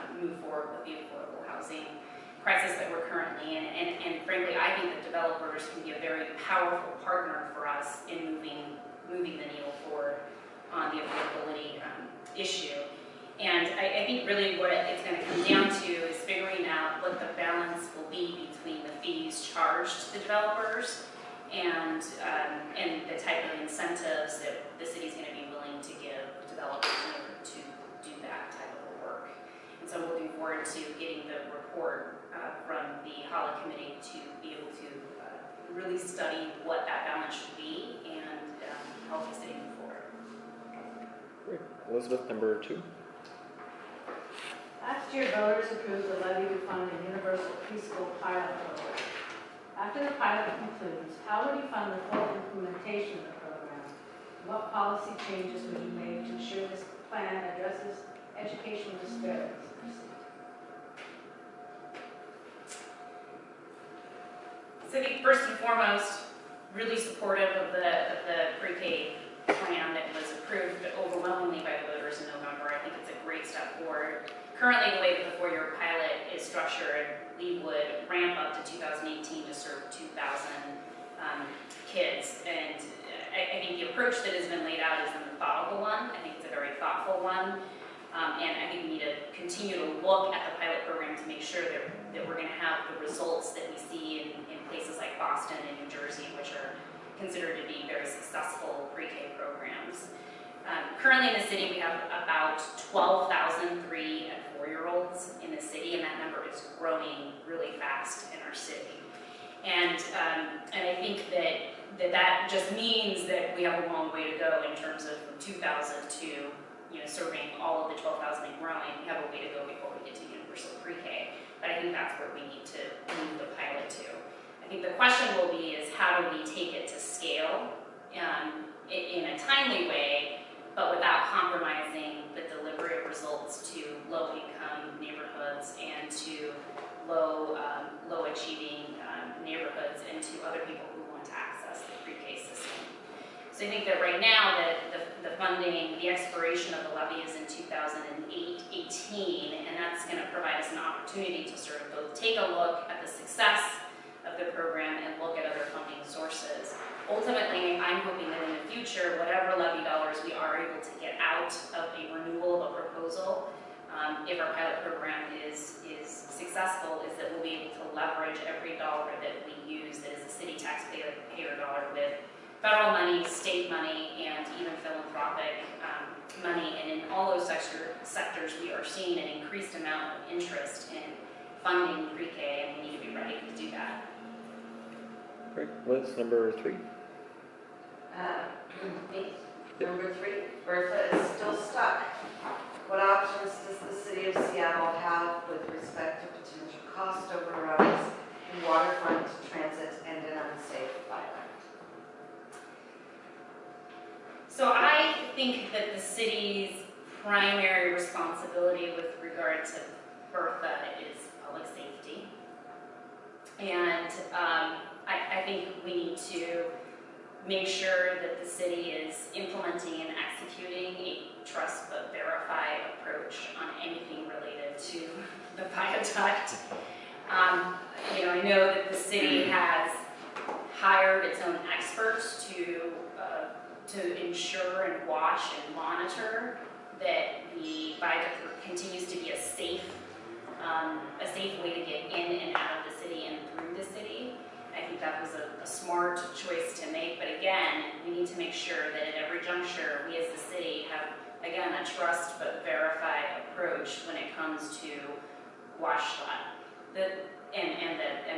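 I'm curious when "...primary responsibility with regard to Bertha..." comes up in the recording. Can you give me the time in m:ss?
3:27.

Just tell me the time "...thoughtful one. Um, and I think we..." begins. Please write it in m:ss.
1:26.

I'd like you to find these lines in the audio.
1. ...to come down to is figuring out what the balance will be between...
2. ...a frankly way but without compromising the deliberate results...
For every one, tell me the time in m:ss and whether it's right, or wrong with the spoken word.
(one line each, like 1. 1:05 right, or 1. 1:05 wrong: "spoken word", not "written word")
1. 0:15 right
2. 2:09 wrong: "timely", not "frankly".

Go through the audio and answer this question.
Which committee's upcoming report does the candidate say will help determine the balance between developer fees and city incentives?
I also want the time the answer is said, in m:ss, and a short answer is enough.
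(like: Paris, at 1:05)
HALA, at 0:33.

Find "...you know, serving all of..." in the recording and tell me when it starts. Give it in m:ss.
1:56.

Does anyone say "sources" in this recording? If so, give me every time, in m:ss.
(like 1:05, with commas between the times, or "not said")
2:36.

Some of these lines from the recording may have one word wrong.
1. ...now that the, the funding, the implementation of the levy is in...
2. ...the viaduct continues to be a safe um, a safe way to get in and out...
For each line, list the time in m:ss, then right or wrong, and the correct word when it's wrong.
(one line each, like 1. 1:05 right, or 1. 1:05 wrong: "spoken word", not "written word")
1. 2:24 wrong: "expiration", not "implementation"
2. 3:57 right.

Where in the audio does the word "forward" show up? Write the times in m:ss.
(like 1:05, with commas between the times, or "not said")
0:00, 0:09, 0:30, 0:39, 1:13.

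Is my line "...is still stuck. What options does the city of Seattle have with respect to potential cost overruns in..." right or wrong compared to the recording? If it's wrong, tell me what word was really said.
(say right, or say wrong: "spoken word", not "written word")
right.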